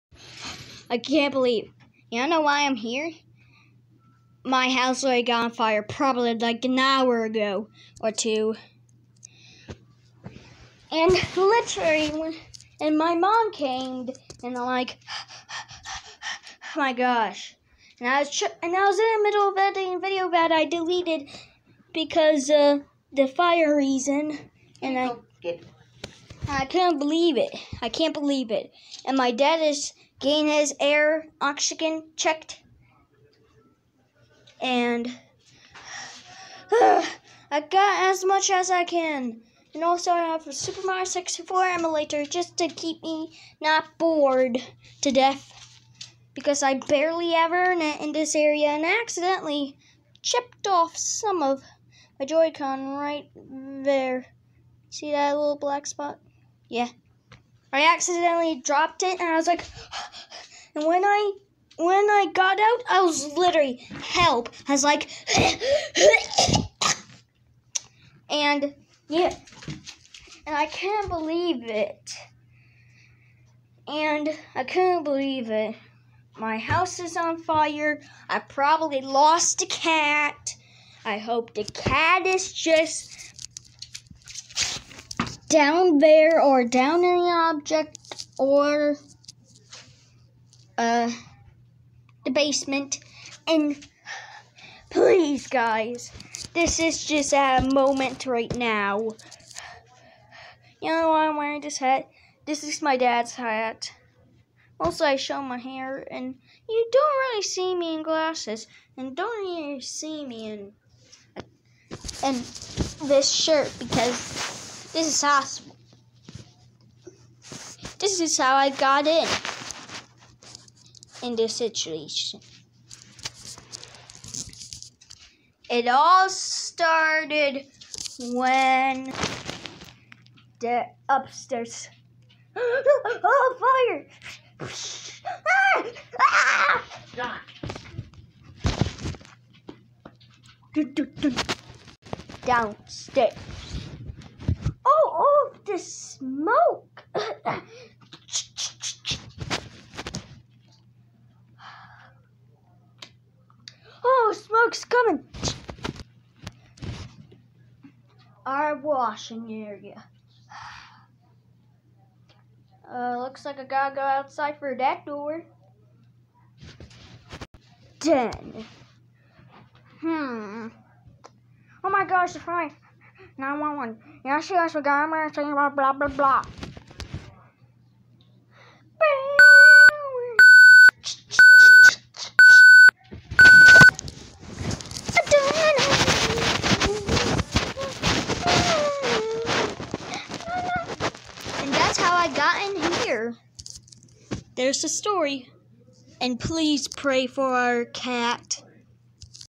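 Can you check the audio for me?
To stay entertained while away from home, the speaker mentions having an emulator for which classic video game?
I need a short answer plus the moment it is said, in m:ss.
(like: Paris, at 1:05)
Super Mario 64, at 0:40.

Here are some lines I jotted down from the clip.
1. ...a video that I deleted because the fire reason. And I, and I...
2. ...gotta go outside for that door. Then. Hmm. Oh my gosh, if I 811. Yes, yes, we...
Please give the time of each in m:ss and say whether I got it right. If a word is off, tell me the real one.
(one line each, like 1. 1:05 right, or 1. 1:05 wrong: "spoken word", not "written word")
1. 0:19 right
2. 2:43 wrong: "911", not "811".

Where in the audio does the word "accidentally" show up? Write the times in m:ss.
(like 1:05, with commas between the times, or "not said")
0:49, 0:57.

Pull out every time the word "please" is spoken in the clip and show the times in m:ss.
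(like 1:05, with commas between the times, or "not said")
1:34, 3:16.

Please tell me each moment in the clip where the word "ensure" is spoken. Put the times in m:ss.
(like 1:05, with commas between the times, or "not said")
not said.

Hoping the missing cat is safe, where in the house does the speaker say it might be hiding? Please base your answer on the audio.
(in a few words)
the basement.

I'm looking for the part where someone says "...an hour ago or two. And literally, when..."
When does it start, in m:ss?
0:06.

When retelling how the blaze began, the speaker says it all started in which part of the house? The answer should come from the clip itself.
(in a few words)
upstairs.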